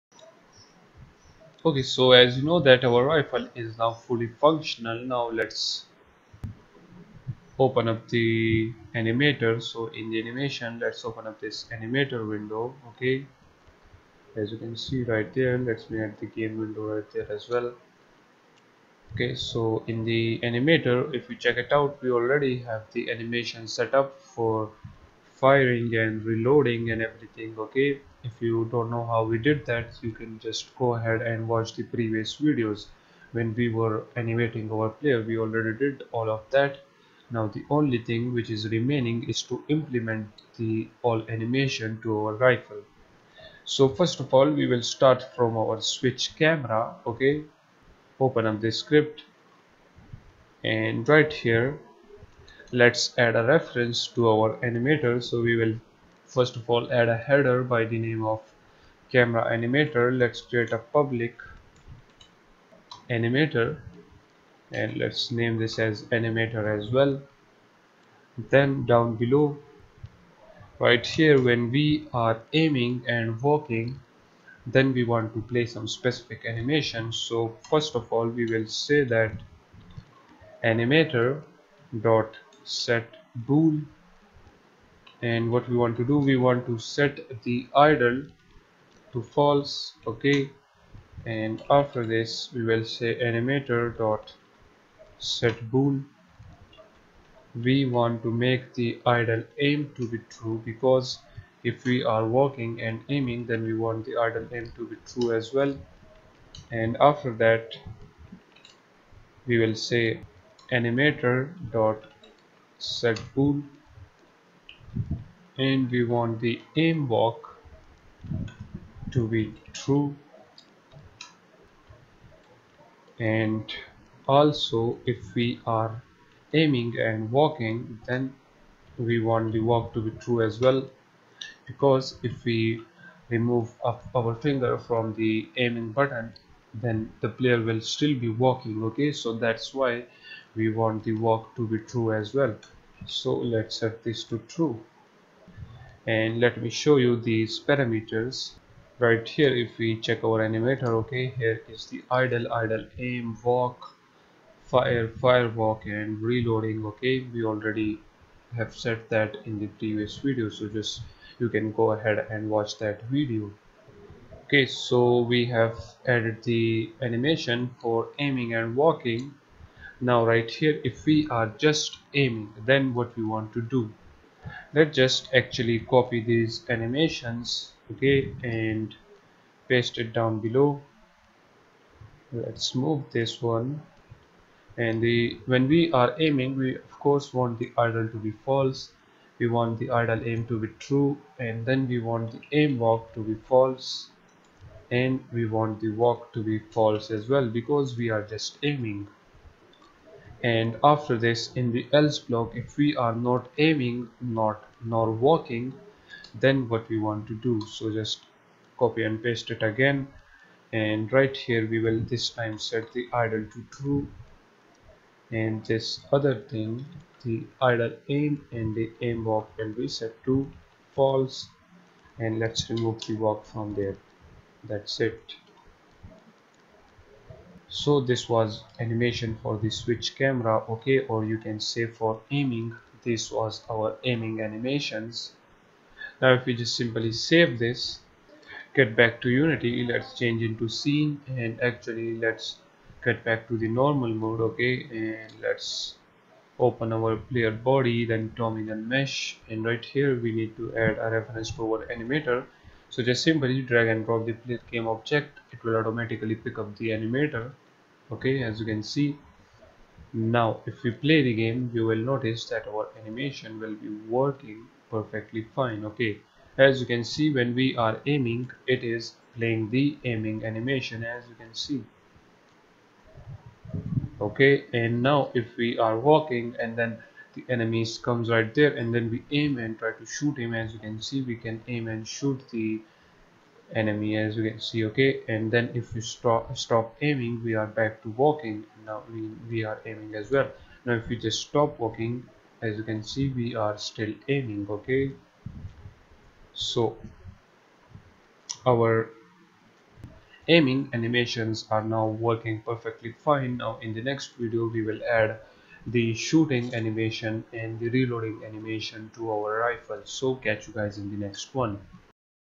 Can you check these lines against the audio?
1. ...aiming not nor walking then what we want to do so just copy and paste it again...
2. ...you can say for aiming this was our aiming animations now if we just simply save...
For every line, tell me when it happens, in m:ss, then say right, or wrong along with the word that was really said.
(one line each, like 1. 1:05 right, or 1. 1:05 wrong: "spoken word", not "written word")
1. 3:23 right
2. 3:51 right.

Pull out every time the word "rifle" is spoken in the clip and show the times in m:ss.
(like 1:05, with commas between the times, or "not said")
0:03, 0:42, 5:09.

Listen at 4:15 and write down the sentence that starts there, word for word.
It will automatically pick up the animator.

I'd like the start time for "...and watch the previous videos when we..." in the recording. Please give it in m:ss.
0:31.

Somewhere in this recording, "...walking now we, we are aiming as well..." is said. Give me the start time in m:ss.
4:48.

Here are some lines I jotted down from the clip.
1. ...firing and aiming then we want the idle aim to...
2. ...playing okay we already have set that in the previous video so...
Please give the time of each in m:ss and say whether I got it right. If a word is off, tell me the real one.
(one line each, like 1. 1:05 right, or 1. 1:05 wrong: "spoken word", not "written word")
1. 1:42 wrong: "walking", not "firing"
2. 2:36 wrong: "reloading", not "playing".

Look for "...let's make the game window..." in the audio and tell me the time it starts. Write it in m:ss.
0:15.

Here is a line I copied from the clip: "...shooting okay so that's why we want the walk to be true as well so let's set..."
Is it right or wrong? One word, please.
wrong.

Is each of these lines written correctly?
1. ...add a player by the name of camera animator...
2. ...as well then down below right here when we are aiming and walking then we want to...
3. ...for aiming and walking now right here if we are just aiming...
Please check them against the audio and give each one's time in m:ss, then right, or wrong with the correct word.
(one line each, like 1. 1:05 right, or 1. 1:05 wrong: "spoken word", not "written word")
1. 0:56 wrong: "header", not "player"
2. 1:06 right
3. 2:47 right.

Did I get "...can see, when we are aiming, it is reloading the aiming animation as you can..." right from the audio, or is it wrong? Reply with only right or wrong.
wrong.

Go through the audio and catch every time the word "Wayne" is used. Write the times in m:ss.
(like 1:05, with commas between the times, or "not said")
not said.